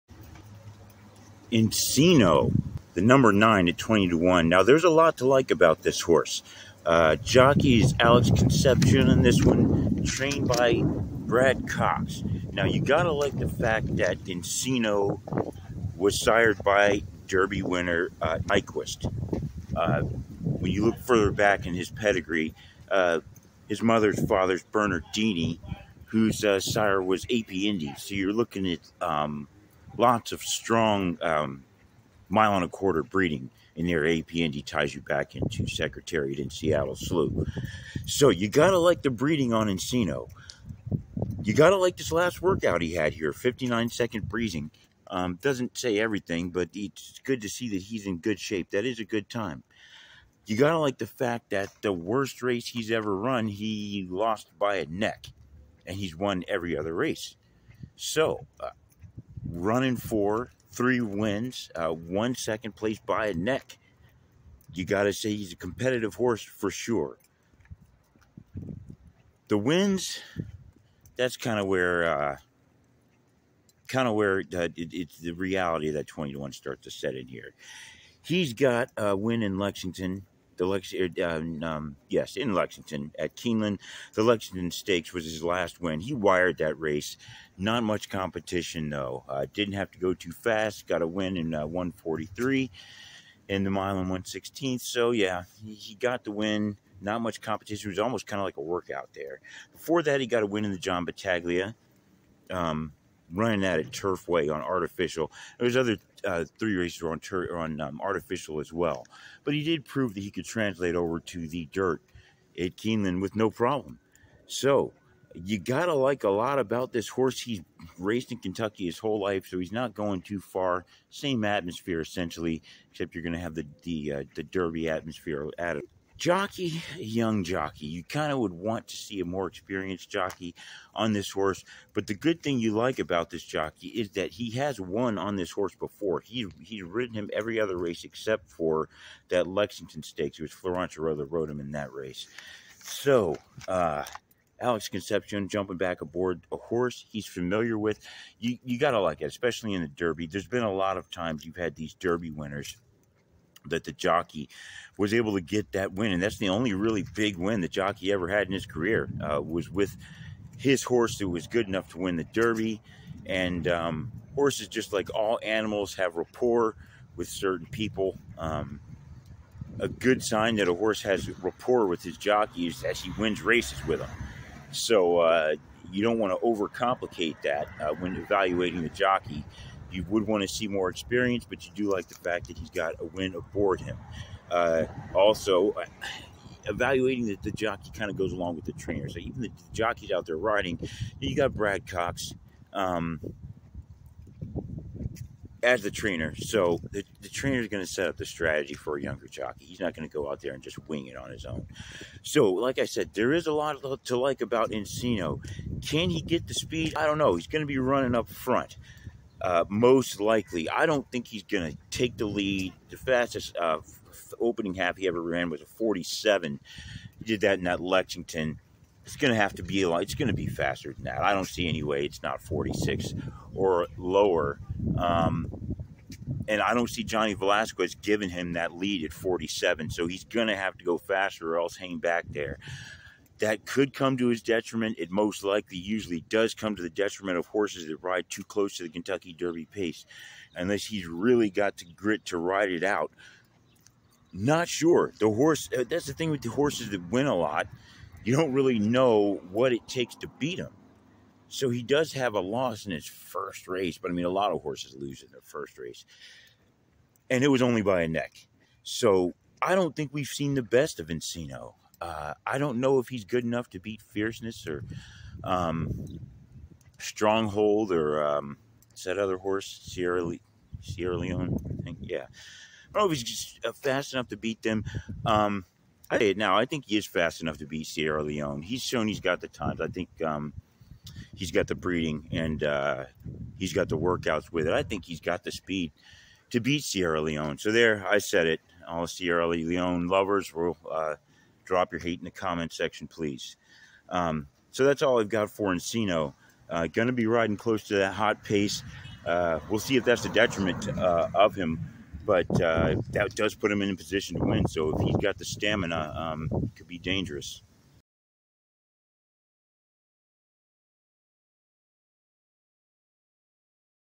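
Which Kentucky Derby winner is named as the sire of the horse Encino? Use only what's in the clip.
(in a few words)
Nyquist.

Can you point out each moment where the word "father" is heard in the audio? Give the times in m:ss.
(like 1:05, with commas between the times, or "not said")
0:24.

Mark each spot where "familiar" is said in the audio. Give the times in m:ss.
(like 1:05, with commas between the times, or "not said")
2:27.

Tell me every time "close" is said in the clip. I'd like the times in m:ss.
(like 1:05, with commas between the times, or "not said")
3:58, 4:57.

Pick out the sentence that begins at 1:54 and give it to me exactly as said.
So you gotta like a lot about this horse.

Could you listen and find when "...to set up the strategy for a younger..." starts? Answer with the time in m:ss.
3:17.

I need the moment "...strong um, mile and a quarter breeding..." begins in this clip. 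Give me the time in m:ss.
0:30.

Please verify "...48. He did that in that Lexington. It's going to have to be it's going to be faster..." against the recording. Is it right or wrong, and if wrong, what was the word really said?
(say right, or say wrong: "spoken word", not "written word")
wrong: "47", not "48".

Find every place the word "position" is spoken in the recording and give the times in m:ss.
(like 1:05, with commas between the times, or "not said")
5:03.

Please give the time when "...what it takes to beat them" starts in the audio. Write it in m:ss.
4:09.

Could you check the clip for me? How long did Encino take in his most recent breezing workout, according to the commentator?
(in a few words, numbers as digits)
59 seconds.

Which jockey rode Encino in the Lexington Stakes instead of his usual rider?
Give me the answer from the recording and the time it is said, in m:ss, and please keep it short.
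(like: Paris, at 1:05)
Florent Geroux, at 2:20.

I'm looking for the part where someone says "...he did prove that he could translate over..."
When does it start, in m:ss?
1:49.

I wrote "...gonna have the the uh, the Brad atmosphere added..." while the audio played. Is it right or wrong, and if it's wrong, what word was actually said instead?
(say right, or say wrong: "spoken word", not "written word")
wrong: "Derby", not "Brad".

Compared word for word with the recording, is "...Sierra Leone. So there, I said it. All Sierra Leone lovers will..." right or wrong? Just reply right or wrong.
right.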